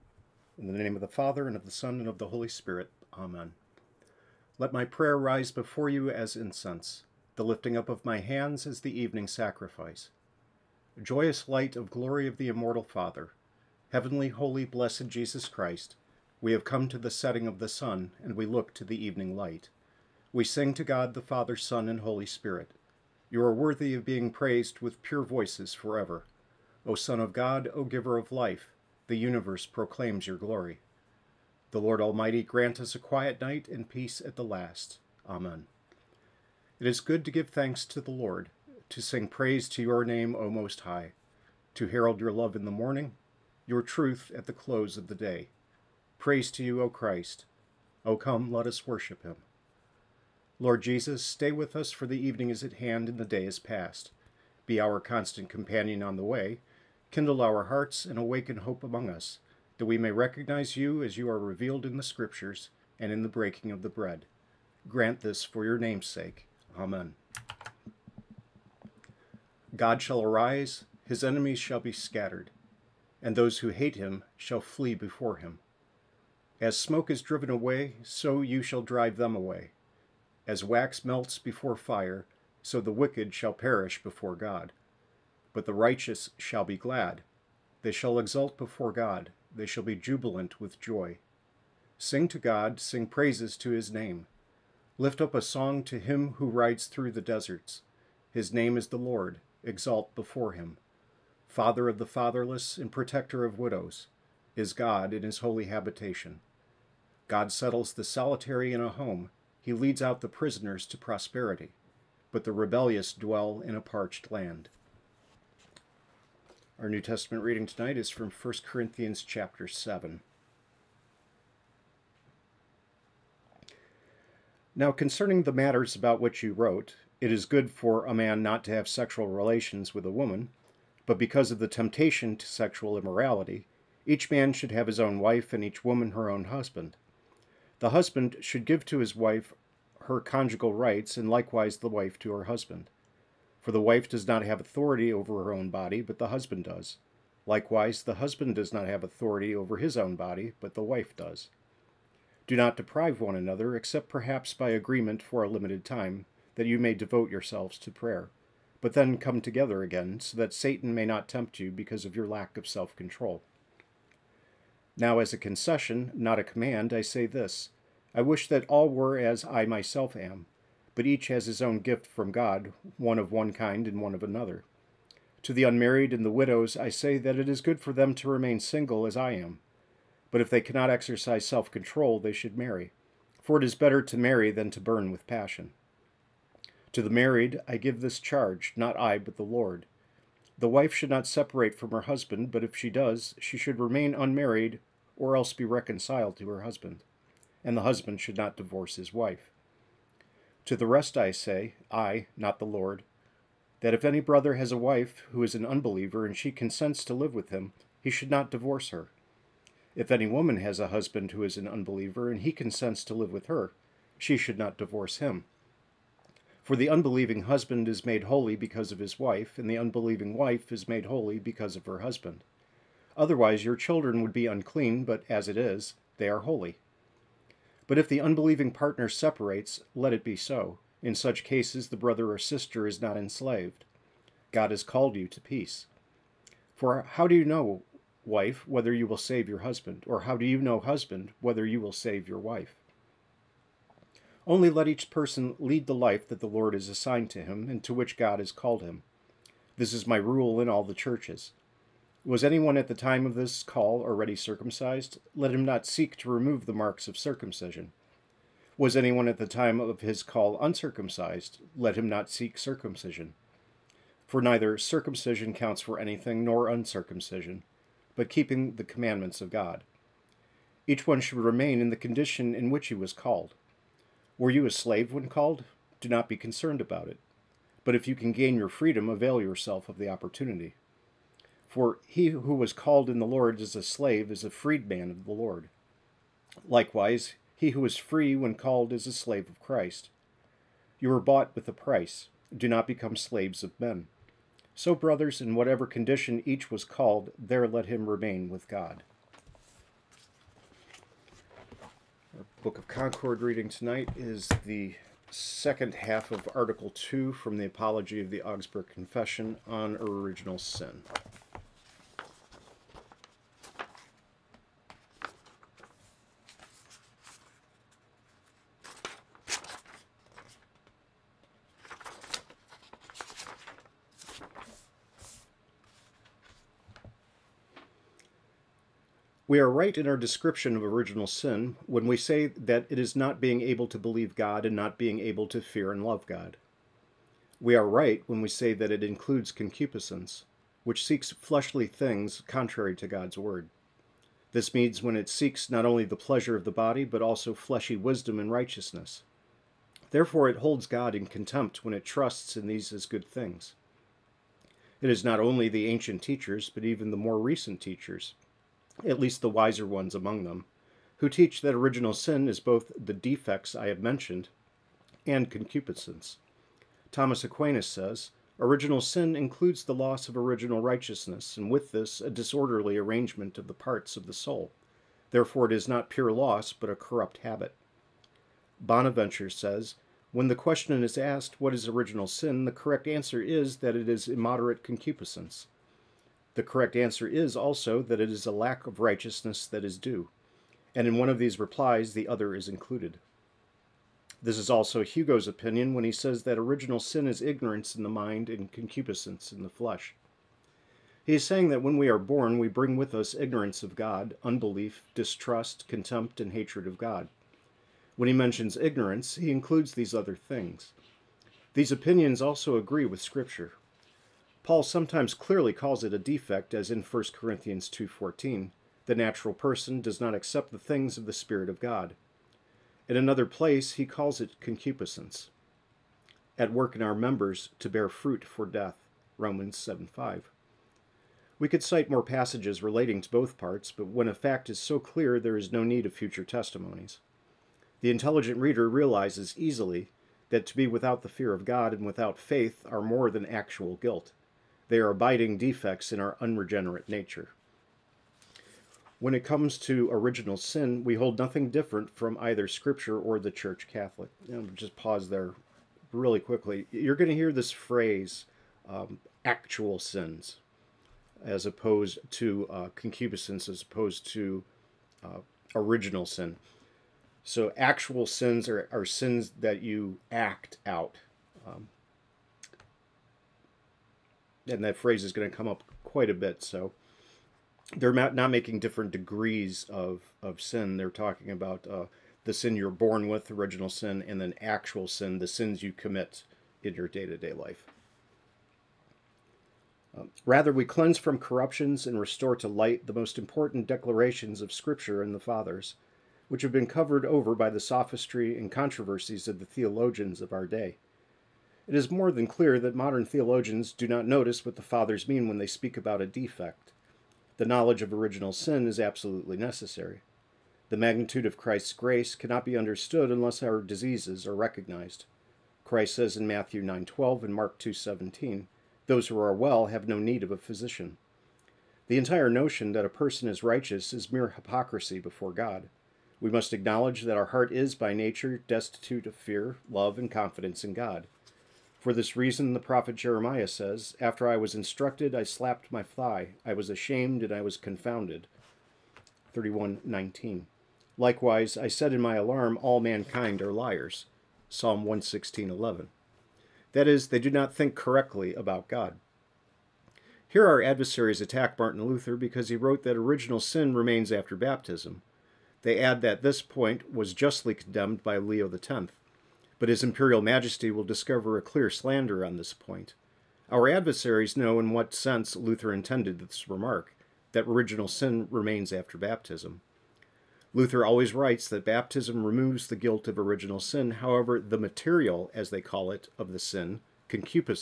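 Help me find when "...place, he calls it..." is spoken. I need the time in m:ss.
7:03.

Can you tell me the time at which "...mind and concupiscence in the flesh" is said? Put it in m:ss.
6:38.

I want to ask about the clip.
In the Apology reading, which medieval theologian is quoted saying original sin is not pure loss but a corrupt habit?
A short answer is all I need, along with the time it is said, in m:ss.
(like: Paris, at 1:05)
Thomas Aquinas, at 6:07.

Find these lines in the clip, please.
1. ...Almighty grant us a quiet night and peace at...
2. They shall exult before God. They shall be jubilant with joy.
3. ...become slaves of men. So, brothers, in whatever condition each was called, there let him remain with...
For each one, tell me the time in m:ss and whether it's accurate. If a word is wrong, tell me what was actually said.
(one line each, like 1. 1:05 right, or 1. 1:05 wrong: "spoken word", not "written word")
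1. 0:32 right
2. 1:27 right
3. 4:52 right.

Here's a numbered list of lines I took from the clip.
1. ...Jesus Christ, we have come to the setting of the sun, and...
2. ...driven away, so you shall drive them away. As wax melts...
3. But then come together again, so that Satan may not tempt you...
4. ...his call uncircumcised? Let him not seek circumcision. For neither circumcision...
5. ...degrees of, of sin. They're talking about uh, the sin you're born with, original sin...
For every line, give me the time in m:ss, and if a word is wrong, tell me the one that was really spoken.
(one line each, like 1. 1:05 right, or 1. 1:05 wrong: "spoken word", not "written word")
1. 0:15 right
2. 1:17 right
3. 2:38 right
4. 4:20 right
5. 7:59 right.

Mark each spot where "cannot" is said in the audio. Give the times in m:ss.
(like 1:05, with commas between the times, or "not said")
3:00, 8:32.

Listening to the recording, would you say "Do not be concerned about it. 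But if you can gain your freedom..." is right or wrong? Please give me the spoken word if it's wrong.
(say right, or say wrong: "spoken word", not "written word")
right.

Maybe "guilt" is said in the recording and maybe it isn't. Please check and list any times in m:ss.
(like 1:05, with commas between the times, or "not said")
7:23, 9:32.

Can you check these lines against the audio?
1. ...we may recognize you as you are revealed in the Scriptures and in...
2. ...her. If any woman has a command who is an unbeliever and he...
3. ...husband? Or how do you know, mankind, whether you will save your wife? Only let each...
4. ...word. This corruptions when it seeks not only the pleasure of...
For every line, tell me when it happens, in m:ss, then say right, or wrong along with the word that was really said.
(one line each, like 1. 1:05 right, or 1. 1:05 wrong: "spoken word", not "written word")
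1. 0:59 right
2. 3:28 wrong: "husband", not "command"
3. 3:59 wrong: "husband", not "mankind"
4. 5:43 wrong: "means", not "corruptions".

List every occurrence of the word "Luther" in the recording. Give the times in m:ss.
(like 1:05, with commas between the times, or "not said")
9:12, 9:25, 9:30.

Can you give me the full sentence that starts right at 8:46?
We must acknowledge that our heart is by nature destitute of fear, love, and confidence in God.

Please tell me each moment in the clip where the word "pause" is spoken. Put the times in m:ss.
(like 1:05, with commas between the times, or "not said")
7:34.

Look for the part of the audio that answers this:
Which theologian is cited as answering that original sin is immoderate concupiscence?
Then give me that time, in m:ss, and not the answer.
6:18.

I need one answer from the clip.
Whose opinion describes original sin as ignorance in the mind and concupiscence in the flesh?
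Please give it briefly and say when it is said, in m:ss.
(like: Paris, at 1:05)
Hugo, at 6:35.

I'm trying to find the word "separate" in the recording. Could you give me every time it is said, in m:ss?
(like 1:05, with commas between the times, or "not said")
3:11, 3:49.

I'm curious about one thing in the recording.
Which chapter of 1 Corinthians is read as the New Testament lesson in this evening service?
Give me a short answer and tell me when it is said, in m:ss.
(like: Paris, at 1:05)
7, at 1:59.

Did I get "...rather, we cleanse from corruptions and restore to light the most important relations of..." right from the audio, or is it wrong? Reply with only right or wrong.
wrong.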